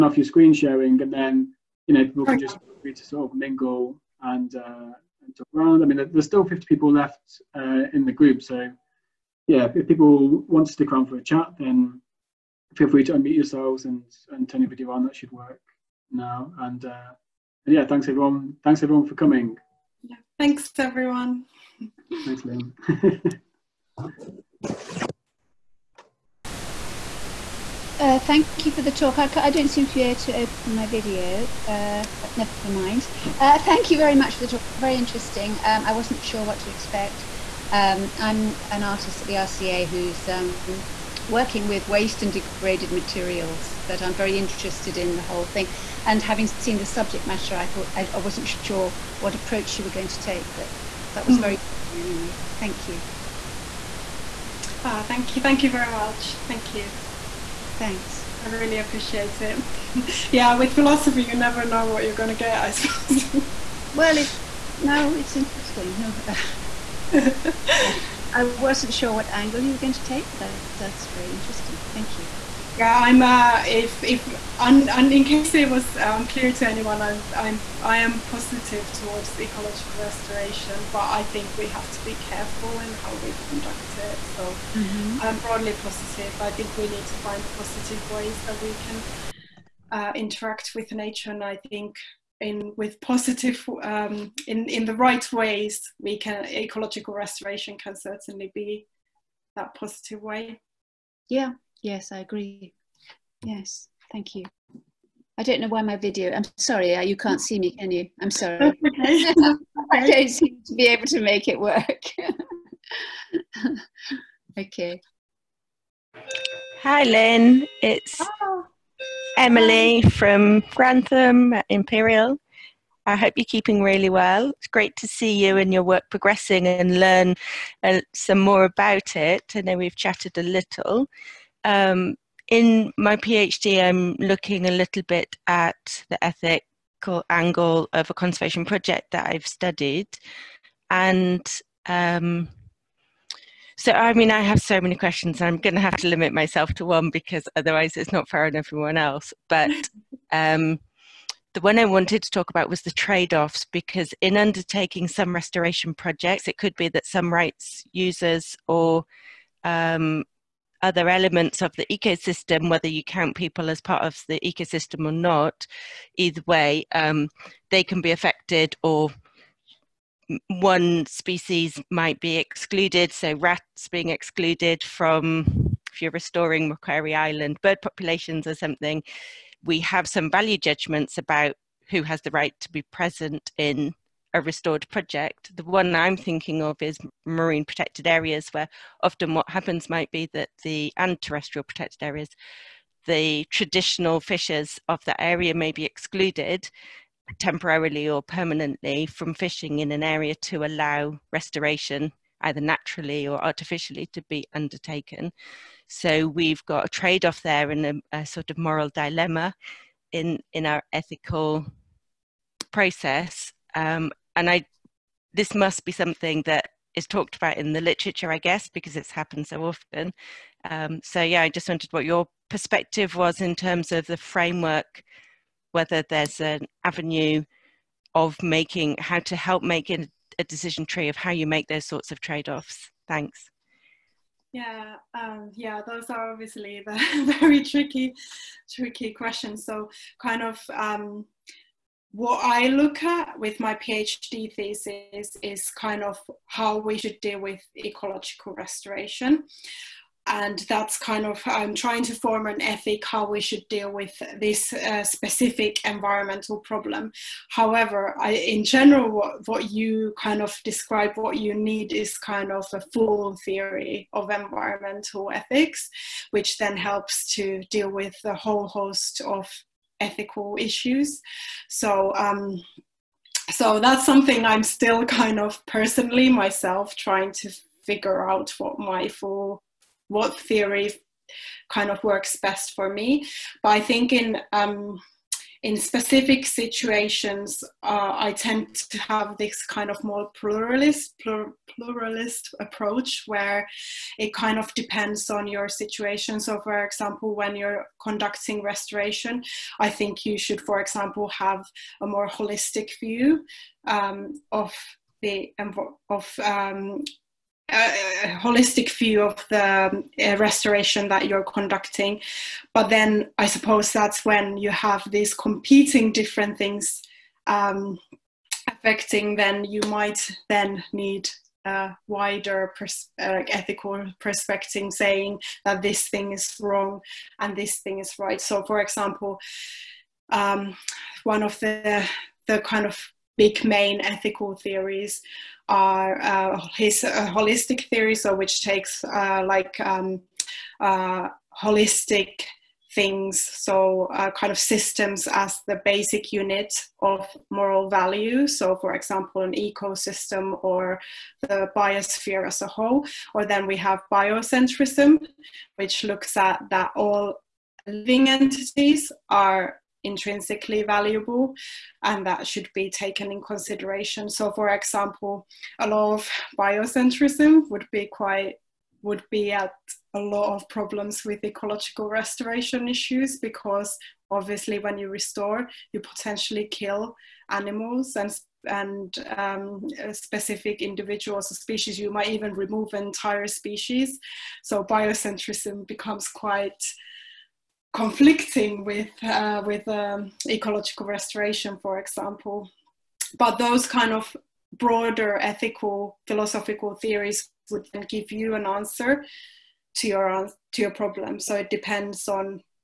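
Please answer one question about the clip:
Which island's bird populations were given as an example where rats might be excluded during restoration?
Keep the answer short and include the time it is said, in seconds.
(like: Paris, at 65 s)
Macquarie Island, at 176 s.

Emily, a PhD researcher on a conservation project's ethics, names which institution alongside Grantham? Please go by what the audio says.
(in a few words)
Imperial.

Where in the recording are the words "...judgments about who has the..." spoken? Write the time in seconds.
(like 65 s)
180 s.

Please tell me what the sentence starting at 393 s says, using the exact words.
But those kind of broader ethical philosophical theories would then give you an answer to your to your problem.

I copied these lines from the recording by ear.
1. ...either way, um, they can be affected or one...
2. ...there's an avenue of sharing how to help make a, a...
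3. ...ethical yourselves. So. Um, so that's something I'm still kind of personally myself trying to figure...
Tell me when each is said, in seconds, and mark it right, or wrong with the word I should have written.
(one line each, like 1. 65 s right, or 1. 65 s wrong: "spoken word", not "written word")
1. 166 s right
2. 226 s wrong: "making", not "sharing"
3. 269 s wrong: "issues", not "yourselves".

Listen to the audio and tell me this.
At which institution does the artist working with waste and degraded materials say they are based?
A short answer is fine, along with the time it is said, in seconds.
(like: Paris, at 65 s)
RCA, at 39 s.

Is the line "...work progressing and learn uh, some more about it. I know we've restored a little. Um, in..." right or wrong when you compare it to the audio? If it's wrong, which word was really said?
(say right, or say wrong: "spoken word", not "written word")
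wrong: "chatted", not "restored".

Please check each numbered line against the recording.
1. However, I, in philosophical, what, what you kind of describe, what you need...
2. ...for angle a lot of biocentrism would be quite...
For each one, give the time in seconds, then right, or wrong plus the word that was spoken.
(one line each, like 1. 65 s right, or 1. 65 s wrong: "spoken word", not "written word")
1. 257 s wrong: "general", not "philosophical"
2. 364 s wrong: "example", not "angle".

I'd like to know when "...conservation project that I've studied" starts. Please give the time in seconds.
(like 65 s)
138 s.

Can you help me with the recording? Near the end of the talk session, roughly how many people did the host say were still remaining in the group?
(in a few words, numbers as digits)
50.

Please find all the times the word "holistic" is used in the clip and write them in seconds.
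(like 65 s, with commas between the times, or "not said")
302 s, 308 s, 337 s, 341 s.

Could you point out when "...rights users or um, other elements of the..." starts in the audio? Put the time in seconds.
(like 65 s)
157 s.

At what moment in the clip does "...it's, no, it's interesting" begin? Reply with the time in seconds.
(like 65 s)
64 s.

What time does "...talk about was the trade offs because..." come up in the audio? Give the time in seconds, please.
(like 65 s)
152 s.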